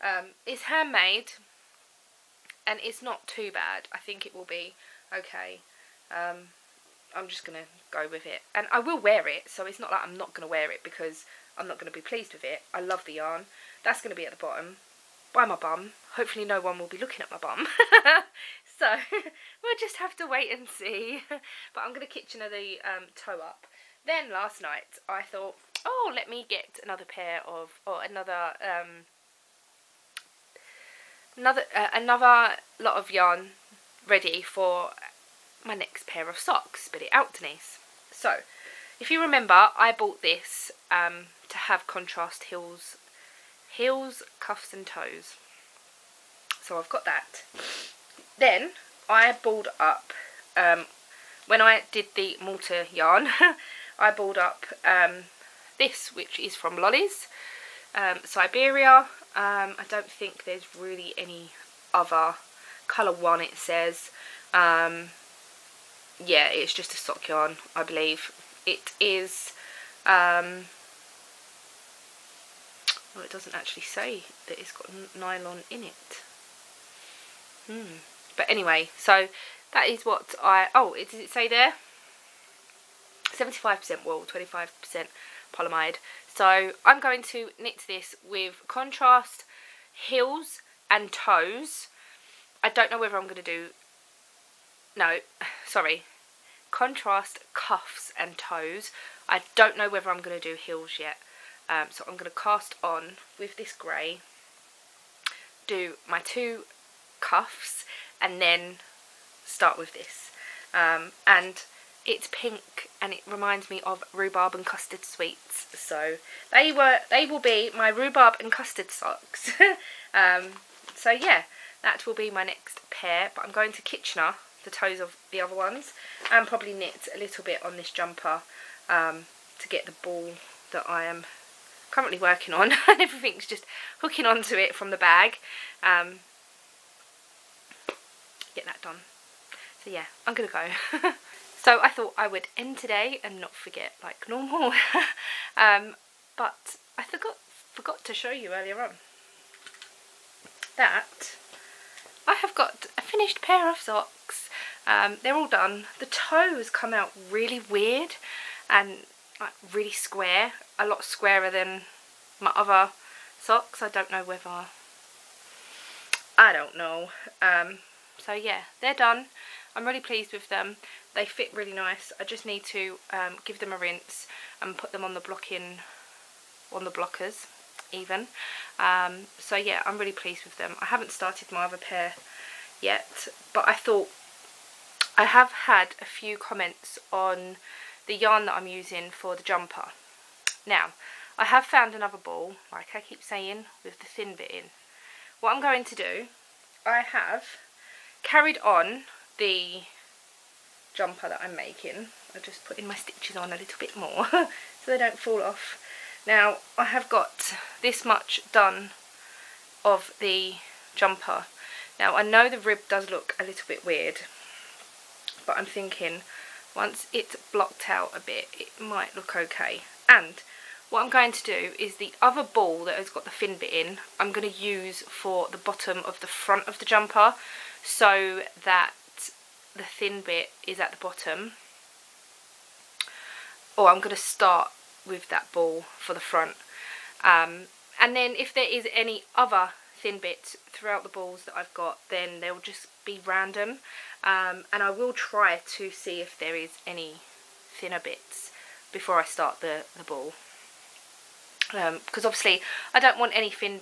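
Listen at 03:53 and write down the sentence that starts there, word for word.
Or oh, I'm going to start with that ball for the front.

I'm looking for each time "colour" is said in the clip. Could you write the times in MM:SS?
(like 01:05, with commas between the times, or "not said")
01:02.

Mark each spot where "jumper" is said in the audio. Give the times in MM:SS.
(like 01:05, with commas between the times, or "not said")
02:07, 03:09, 03:20, 03:30, 03:46.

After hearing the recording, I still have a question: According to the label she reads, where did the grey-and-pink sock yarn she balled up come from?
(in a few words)
Lolly's.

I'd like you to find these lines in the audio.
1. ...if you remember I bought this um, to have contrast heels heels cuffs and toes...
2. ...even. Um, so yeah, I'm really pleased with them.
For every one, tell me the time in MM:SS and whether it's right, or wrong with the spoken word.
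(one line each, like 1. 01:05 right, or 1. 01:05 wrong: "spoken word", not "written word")
1. 00:38 right
2. 02:57 right.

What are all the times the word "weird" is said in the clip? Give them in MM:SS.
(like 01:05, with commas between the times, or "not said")
02:37, 03:33.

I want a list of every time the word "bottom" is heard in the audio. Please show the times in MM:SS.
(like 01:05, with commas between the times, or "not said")
00:14, 03:45, 03:50.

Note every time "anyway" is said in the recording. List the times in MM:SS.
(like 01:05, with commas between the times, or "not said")
01:18.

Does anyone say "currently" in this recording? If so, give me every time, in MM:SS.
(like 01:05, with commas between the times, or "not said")
02:11.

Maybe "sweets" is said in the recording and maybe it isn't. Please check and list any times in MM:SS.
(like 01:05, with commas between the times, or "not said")
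01:55.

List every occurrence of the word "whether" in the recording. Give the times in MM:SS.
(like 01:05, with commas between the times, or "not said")
01:32, 01:39, 02:44.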